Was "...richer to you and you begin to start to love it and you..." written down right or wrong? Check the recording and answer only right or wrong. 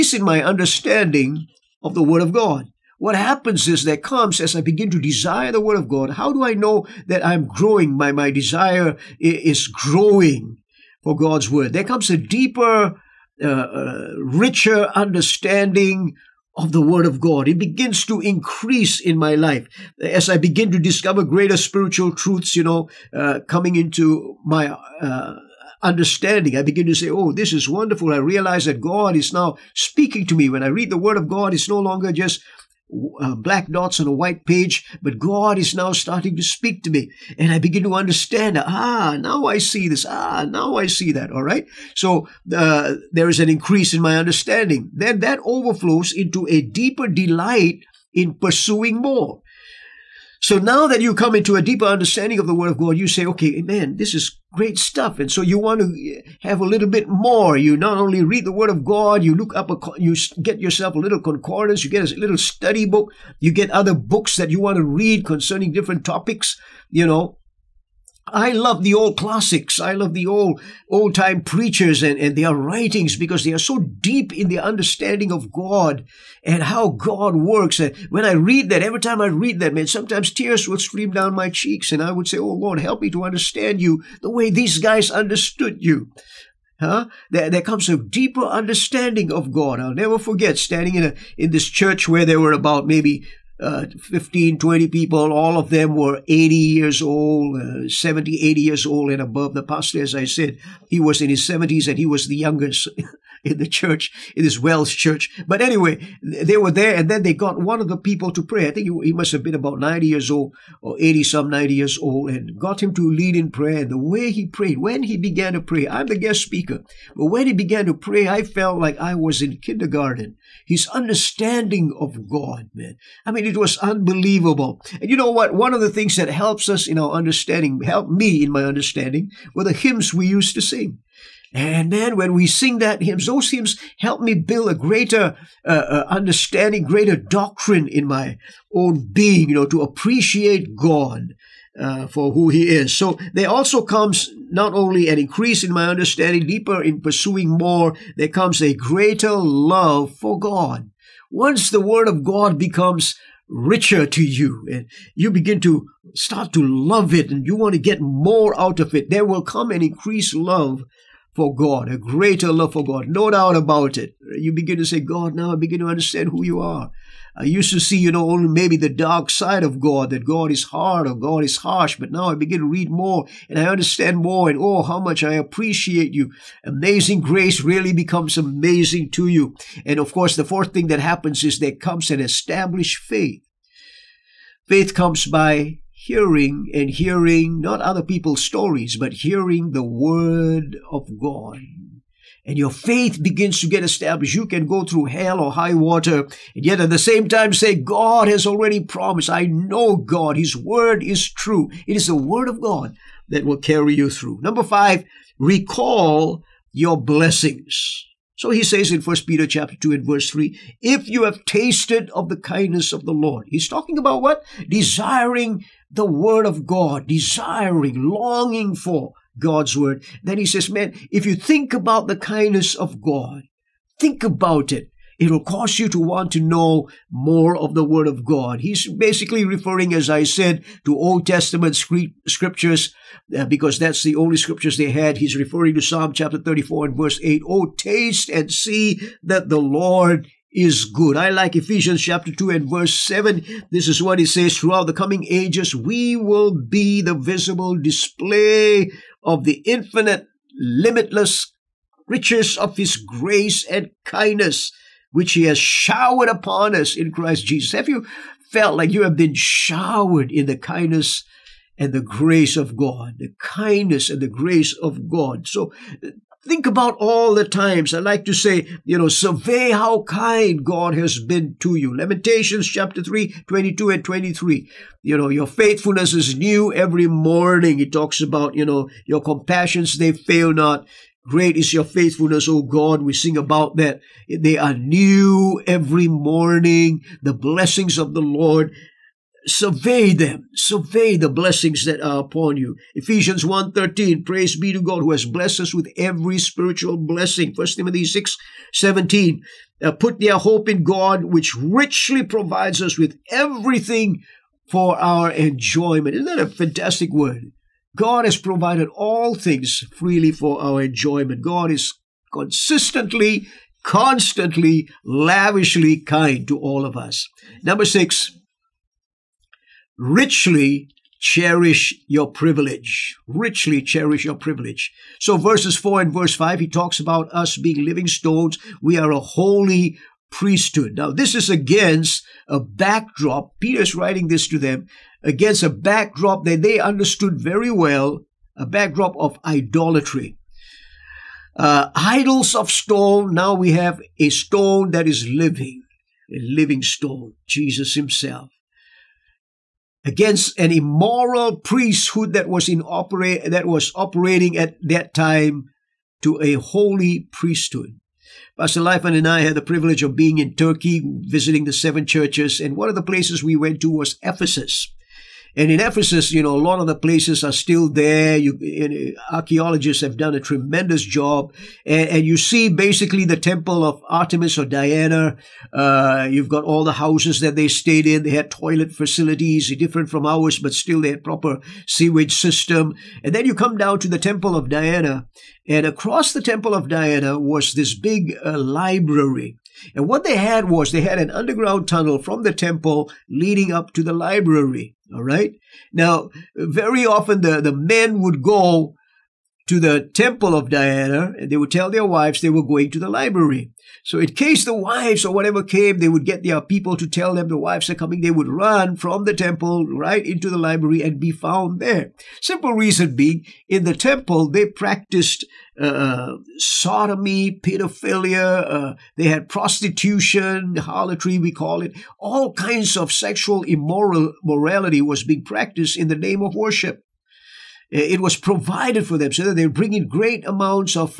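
right.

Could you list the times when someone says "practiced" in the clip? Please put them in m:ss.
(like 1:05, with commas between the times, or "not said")
6:54, 7:05.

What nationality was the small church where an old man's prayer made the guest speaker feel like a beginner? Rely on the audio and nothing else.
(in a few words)
Welsh.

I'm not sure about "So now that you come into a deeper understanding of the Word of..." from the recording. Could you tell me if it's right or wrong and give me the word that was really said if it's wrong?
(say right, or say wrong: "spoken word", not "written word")
right.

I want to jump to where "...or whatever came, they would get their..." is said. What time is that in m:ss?
6:45.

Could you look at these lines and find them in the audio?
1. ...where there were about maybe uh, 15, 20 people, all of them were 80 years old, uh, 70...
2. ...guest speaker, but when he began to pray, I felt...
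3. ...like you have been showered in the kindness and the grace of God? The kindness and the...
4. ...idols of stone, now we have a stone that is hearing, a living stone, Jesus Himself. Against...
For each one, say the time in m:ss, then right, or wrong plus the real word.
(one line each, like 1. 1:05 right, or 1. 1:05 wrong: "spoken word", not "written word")
1. 1:32 right
2. 1:56 right
3. 4:18 right
4. 5:41 wrong: "living", not "hearing".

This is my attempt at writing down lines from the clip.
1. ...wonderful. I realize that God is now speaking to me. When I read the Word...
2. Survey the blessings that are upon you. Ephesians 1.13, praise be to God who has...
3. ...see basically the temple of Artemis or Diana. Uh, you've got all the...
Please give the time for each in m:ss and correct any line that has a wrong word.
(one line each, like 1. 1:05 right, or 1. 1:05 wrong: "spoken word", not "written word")
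1. 0:27 right
2. 4:50 right
3. 6:12 right.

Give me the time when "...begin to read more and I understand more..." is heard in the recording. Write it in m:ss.
2:52.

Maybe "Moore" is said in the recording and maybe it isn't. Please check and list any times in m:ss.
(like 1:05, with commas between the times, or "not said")
not said.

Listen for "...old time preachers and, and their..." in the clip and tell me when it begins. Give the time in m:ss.
1:10.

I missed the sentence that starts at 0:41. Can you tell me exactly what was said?
So uh, there is an increase in my understanding.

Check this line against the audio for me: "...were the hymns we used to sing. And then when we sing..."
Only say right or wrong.
right.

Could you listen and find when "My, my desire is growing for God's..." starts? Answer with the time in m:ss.
0:07.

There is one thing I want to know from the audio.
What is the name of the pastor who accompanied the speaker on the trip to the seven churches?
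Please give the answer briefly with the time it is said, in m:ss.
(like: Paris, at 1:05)
Lifan, at 5:58.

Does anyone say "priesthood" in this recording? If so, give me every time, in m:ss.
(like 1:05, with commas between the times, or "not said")
5:30, 5:51, 5:57.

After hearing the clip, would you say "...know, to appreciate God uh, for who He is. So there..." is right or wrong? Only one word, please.
right.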